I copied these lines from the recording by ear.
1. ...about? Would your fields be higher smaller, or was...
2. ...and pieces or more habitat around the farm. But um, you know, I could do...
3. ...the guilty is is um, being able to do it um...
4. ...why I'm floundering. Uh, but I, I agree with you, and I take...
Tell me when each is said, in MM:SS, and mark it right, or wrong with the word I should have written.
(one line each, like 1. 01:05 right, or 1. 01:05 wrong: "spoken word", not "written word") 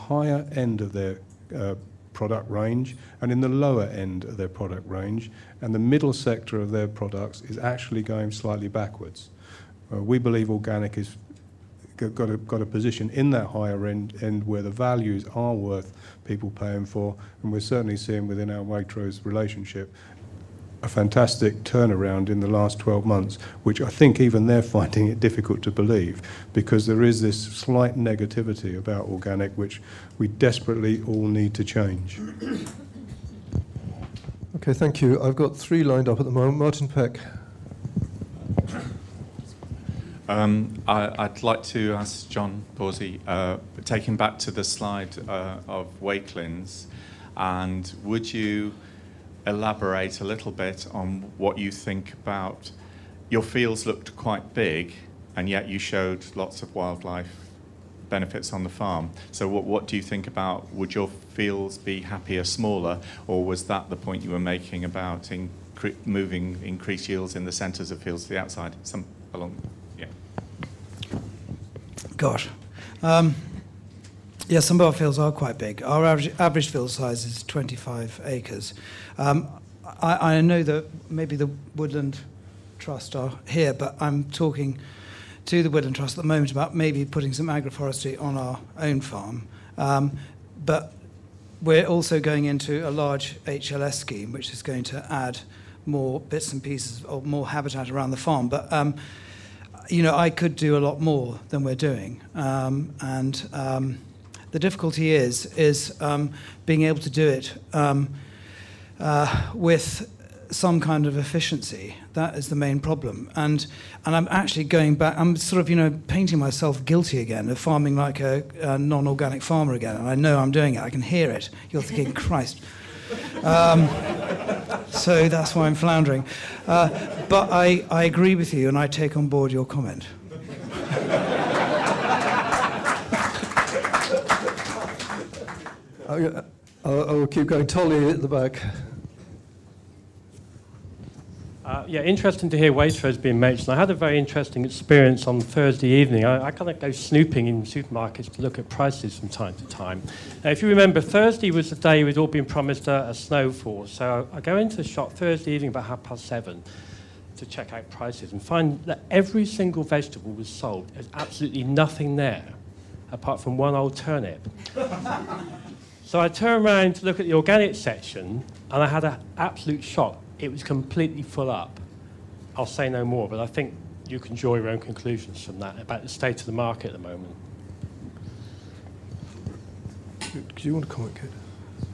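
1. 01:00 wrong: "happier", not "higher"
2. 01:36 right
3. 01:44 wrong: "difficulty", not "guilty"
4. 02:05 right.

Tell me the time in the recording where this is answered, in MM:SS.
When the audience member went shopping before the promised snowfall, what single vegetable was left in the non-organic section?
02:43.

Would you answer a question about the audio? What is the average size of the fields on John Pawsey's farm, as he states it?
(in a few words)
25 acres.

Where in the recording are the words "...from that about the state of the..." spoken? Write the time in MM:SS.
02:55.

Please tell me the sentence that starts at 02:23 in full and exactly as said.
I had a very interesting experience on Thursday evening.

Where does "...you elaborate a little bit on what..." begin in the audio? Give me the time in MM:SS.
00:48.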